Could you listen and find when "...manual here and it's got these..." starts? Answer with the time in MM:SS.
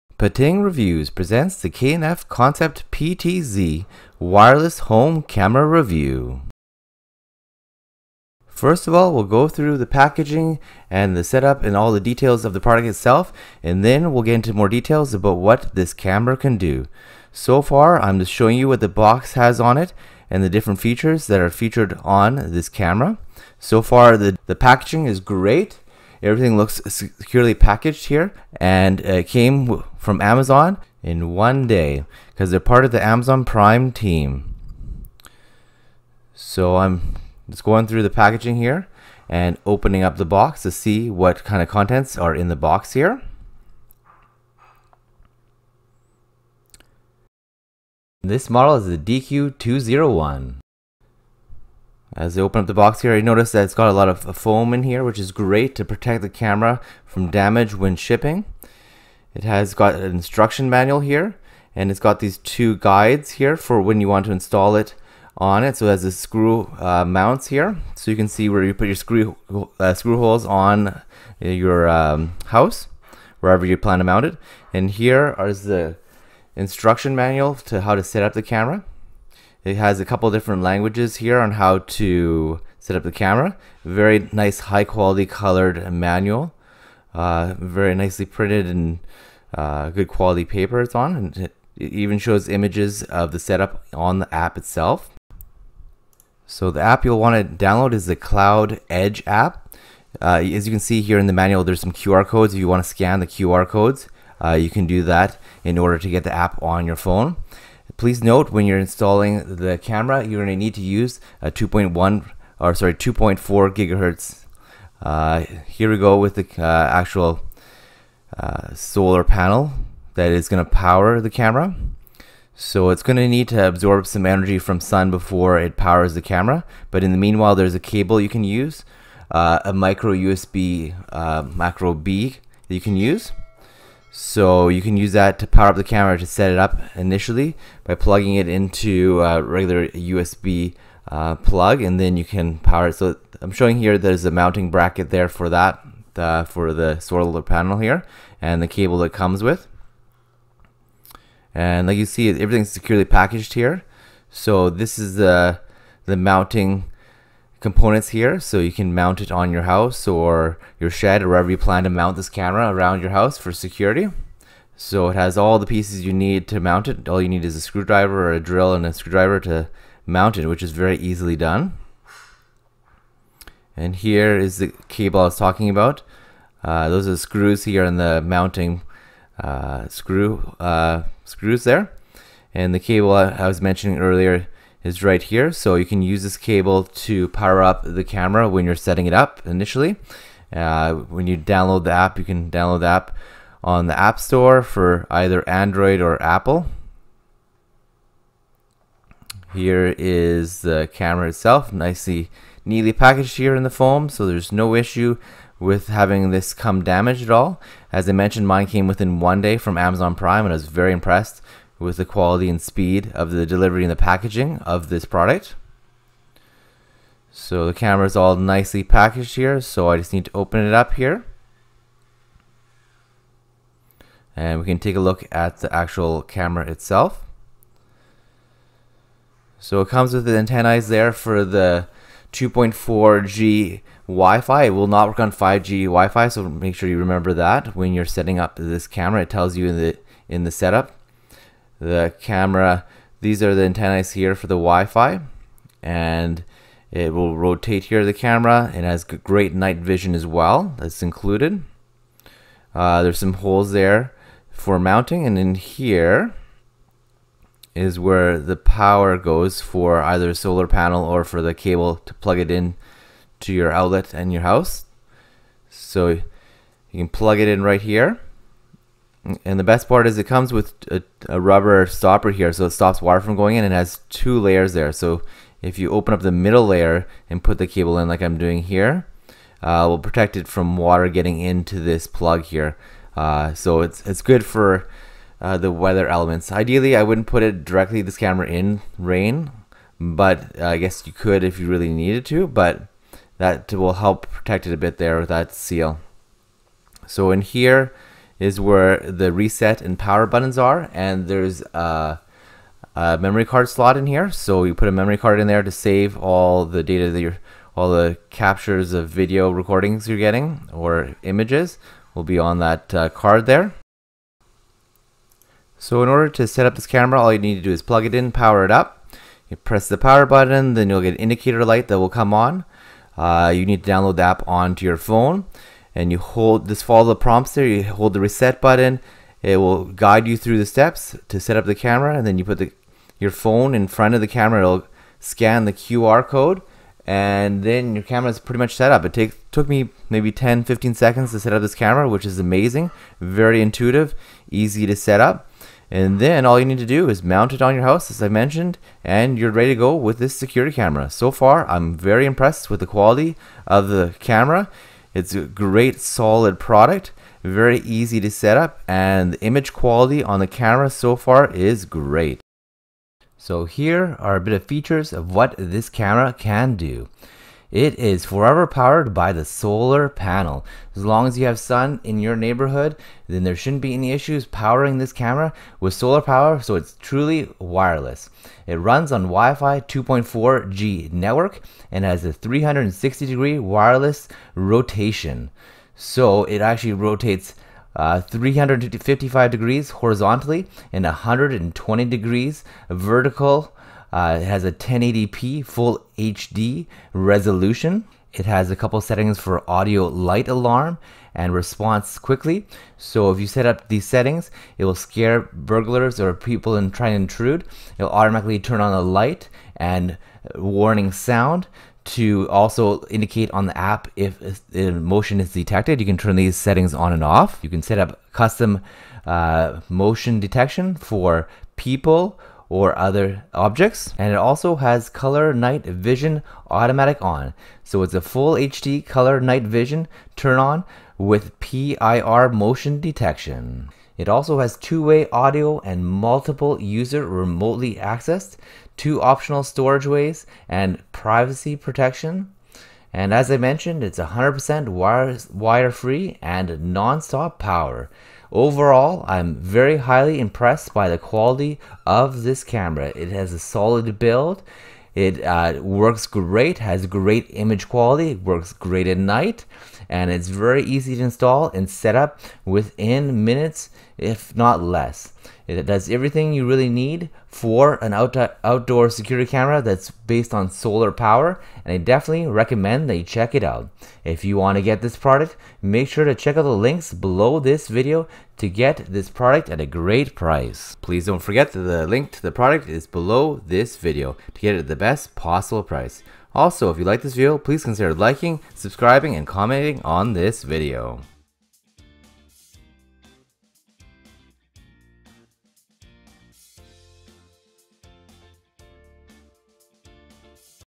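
01:00.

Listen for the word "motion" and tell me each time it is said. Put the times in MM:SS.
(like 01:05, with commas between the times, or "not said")
06:54, 06:59, 07:12.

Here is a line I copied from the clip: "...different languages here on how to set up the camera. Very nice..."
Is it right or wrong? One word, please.
right.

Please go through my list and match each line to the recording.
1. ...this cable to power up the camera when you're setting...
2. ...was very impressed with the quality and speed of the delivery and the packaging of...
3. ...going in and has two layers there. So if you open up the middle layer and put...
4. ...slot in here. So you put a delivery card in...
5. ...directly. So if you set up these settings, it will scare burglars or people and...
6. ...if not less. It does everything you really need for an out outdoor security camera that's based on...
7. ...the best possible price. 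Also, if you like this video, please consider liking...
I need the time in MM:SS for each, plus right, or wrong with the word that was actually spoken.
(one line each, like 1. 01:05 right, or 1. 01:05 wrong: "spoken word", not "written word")
1. 03:06 right
2. 03:30 right
3. 04:33 right
4. 05:03 wrong: "memory", not "delivery"
5. 06:42 wrong: "quickly", not "directly"
6. 07:44 right
7. 08:04 right.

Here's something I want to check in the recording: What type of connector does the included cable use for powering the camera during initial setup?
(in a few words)
micro USB.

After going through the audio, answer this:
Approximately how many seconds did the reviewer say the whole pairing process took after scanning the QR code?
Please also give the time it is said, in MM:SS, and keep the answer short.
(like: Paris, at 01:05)
10-15 seconds, at 05:40.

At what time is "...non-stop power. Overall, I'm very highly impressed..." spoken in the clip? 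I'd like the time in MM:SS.
07:26.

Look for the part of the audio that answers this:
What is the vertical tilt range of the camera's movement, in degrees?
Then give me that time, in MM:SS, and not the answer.
06:31.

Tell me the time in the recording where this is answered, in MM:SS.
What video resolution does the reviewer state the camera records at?
06:34.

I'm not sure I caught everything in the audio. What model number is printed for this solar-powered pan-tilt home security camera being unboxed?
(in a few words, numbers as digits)
DQ201.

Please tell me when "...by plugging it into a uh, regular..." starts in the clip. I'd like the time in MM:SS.
02:17.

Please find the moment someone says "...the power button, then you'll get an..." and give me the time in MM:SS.
05:19.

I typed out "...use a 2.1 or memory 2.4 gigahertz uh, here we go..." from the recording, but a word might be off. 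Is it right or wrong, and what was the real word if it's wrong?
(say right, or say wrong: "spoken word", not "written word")
wrong: "sorry", not "memory".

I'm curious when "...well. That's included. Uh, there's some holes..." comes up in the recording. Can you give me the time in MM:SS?
04:10.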